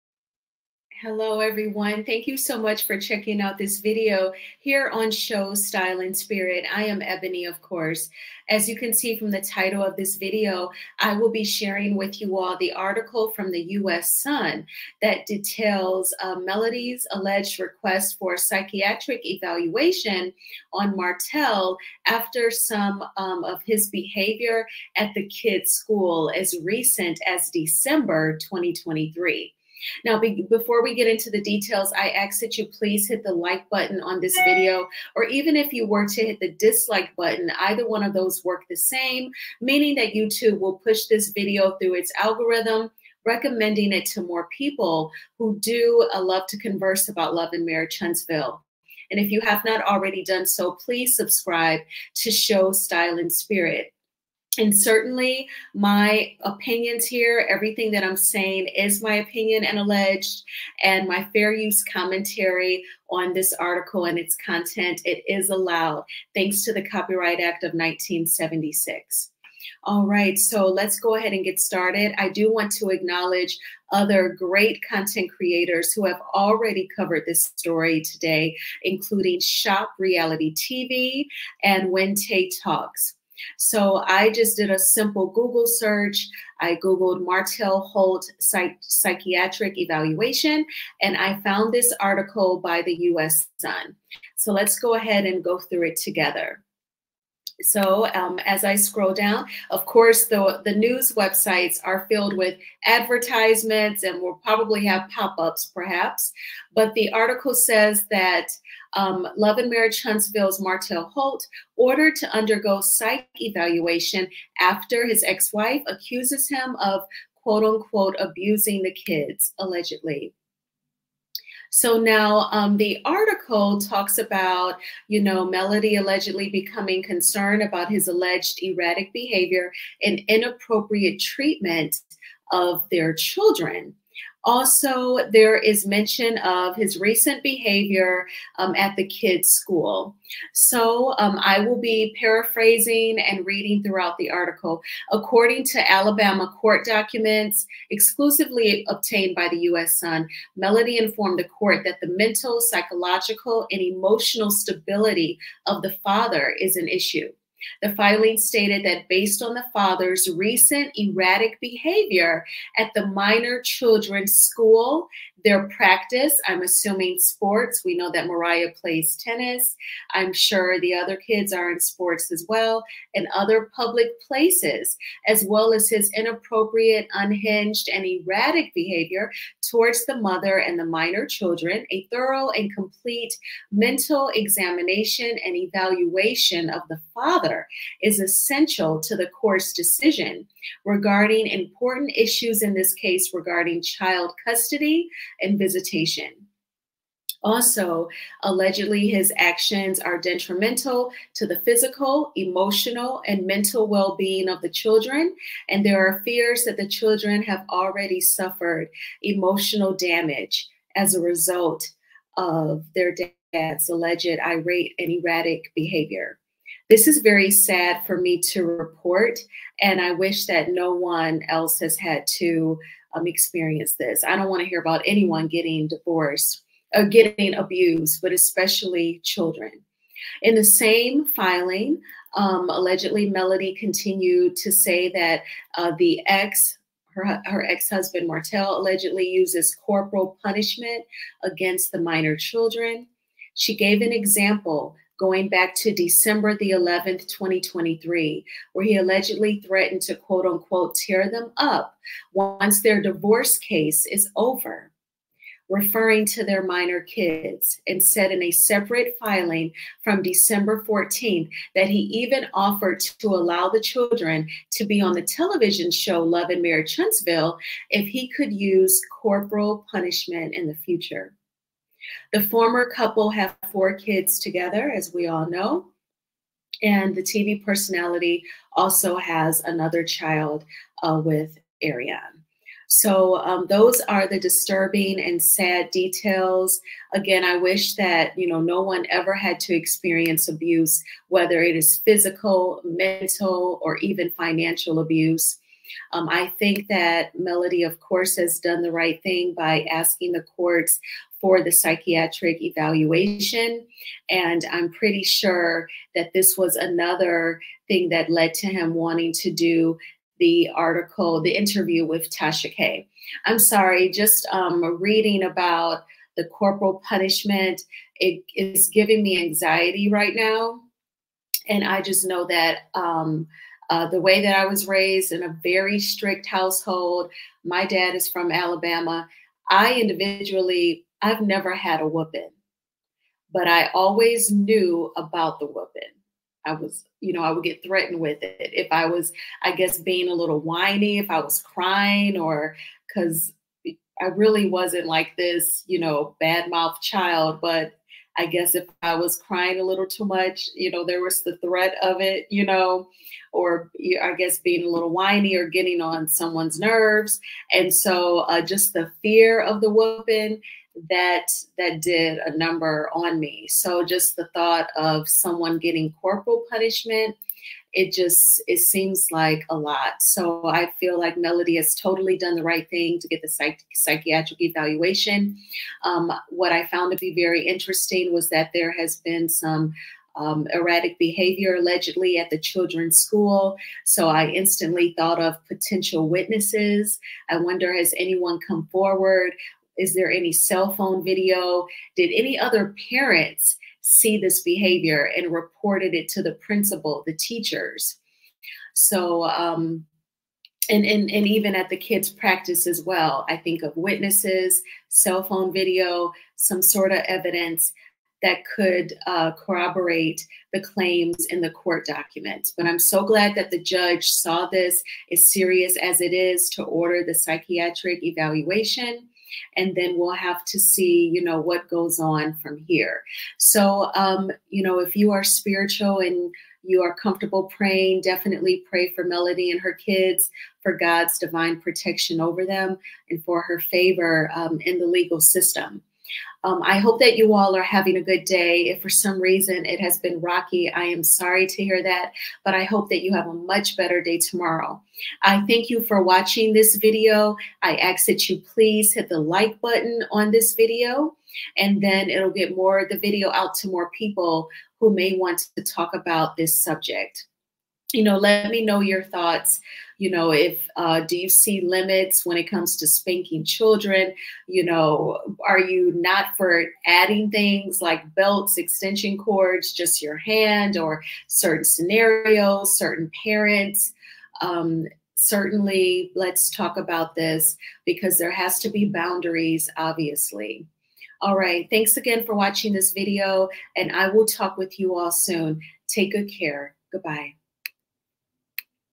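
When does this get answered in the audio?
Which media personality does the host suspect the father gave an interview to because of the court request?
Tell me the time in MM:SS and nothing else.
05:12.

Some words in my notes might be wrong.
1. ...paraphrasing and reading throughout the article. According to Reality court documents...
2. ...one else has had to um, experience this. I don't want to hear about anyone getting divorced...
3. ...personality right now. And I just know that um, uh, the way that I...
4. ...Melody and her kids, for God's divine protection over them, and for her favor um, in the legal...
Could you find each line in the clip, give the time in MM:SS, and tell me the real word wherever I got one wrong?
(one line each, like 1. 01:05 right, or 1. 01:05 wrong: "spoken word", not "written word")
1. 02:22 wrong: "Alabama", not "Reality"
2. 03:40 right
3. 05:19 wrong: "anxiety", not "personality"
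4. 07:09 right.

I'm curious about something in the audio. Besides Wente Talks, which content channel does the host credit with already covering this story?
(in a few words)
Shop Reality TV.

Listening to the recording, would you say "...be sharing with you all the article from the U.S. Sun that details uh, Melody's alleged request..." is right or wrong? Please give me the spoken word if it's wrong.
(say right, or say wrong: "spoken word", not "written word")
right.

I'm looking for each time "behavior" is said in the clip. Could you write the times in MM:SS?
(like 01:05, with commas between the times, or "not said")
00:23, 02:09, 02:17, 02:41, 02:58, 03:35, 06:21, 06:34.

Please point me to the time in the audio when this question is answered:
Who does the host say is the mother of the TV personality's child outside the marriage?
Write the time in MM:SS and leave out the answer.
04:41.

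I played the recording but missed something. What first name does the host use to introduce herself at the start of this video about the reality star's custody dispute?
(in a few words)
Ebony.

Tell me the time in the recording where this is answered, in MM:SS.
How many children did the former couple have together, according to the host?
04:33.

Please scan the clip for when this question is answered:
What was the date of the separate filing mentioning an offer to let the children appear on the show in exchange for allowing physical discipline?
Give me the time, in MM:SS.
04:20.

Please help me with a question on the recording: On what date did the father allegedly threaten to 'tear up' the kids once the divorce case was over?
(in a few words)
December 11.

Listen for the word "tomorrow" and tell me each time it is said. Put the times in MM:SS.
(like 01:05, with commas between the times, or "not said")
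07:24.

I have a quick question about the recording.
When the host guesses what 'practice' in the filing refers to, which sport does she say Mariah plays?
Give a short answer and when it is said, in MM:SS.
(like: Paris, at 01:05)
Tennis, at 02:49.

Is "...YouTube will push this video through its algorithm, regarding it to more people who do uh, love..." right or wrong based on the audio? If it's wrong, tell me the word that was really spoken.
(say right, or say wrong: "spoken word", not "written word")
wrong: "recommending", not "regarding".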